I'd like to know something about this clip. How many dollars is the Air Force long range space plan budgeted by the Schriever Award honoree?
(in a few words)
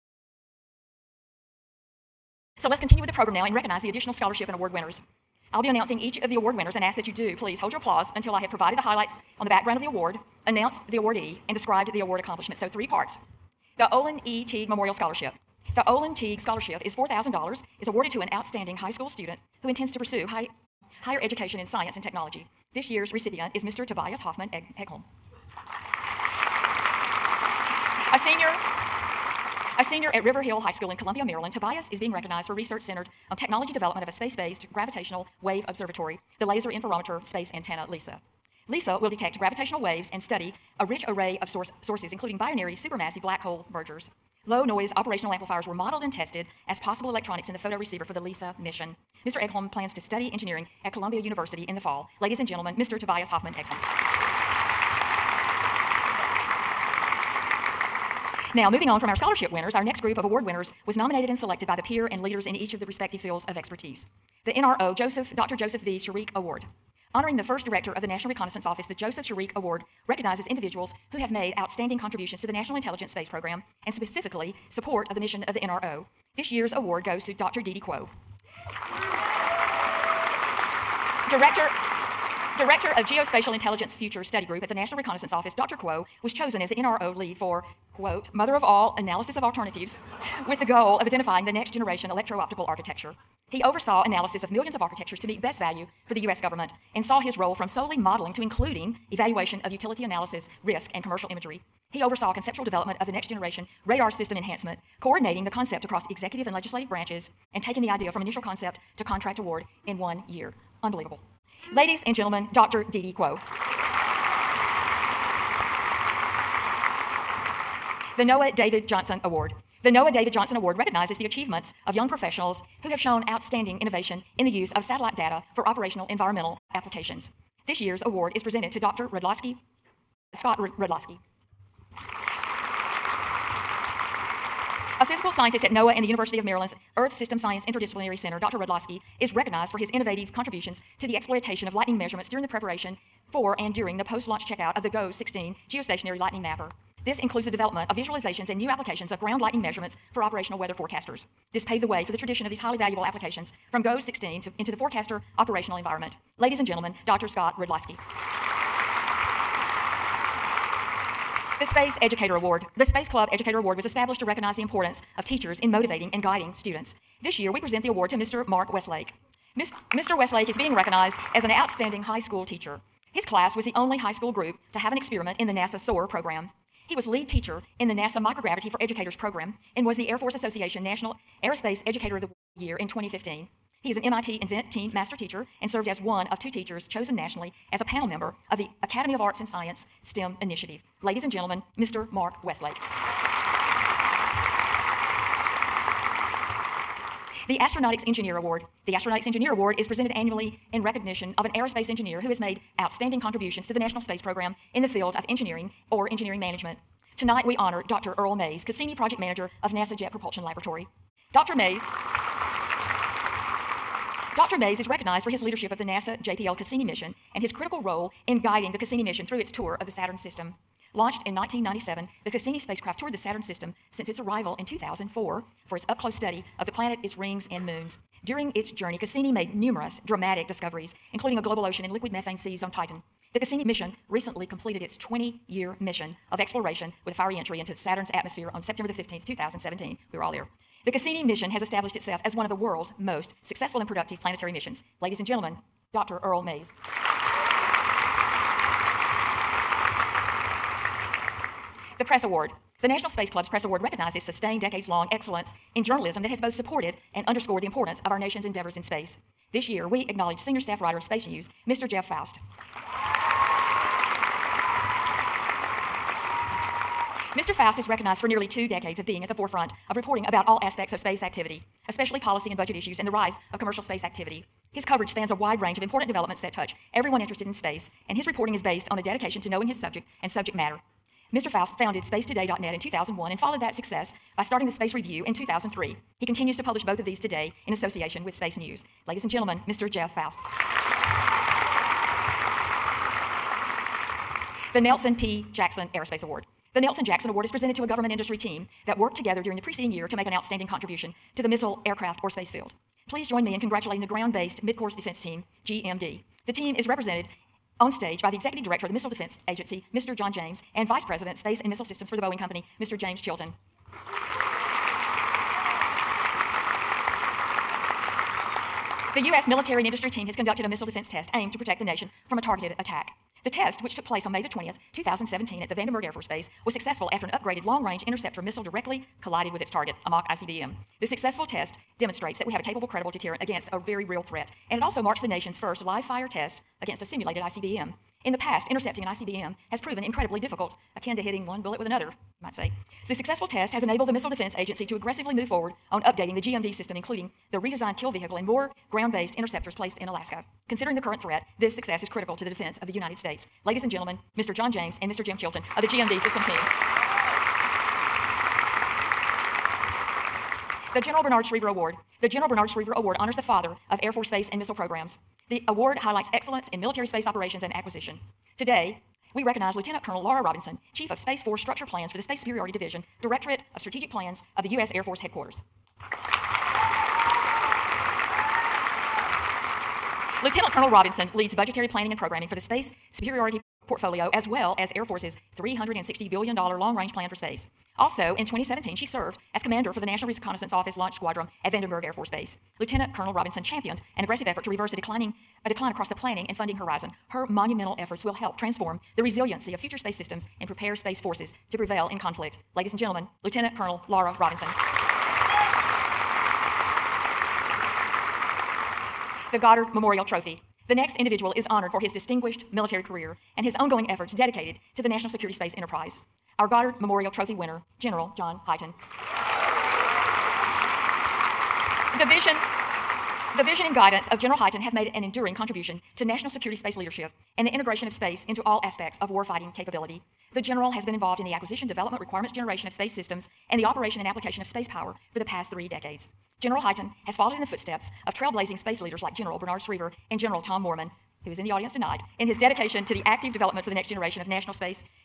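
$360 billion.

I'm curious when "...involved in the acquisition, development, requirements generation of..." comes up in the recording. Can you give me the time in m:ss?
7:11.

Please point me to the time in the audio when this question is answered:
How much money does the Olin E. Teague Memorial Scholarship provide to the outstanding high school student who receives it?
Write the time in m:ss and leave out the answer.
0:16.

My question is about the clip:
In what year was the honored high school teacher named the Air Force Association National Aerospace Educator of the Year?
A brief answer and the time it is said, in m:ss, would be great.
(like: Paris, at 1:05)
2015, at 3:02.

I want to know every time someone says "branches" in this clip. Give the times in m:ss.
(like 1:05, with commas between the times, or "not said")
1:46.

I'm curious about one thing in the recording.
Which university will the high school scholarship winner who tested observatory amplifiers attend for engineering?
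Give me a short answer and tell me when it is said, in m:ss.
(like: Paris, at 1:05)
Columbia University, at 0:50.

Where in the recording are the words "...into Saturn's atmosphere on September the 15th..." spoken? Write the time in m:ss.
3:57.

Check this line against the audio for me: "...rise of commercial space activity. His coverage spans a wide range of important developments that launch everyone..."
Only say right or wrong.
wrong.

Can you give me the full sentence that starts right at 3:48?
During its journey, Cassini made numerous dramatic discoveries, including a global ocean and liquid methane seas on Titan.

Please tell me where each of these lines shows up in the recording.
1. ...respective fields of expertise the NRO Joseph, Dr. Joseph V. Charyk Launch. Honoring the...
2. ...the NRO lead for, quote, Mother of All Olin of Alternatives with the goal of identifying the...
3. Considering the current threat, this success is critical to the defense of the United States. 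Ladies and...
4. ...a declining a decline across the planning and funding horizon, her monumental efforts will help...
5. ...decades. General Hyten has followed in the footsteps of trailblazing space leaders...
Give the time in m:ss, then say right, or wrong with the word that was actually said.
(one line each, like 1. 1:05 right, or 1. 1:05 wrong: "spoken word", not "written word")
1. 1:02 wrong: "Award", not "Launch"
2. 1:26 wrong: "Analysis", not "Olin"
3. 5:50 right
4. 6:34 right
5. 7:15 right.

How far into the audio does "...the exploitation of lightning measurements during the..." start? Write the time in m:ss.
2:21.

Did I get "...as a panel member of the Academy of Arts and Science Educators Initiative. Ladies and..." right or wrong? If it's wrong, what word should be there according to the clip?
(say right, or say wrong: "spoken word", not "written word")
wrong: "STEM", not "Educators".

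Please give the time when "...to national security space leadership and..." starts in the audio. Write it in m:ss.
7:06.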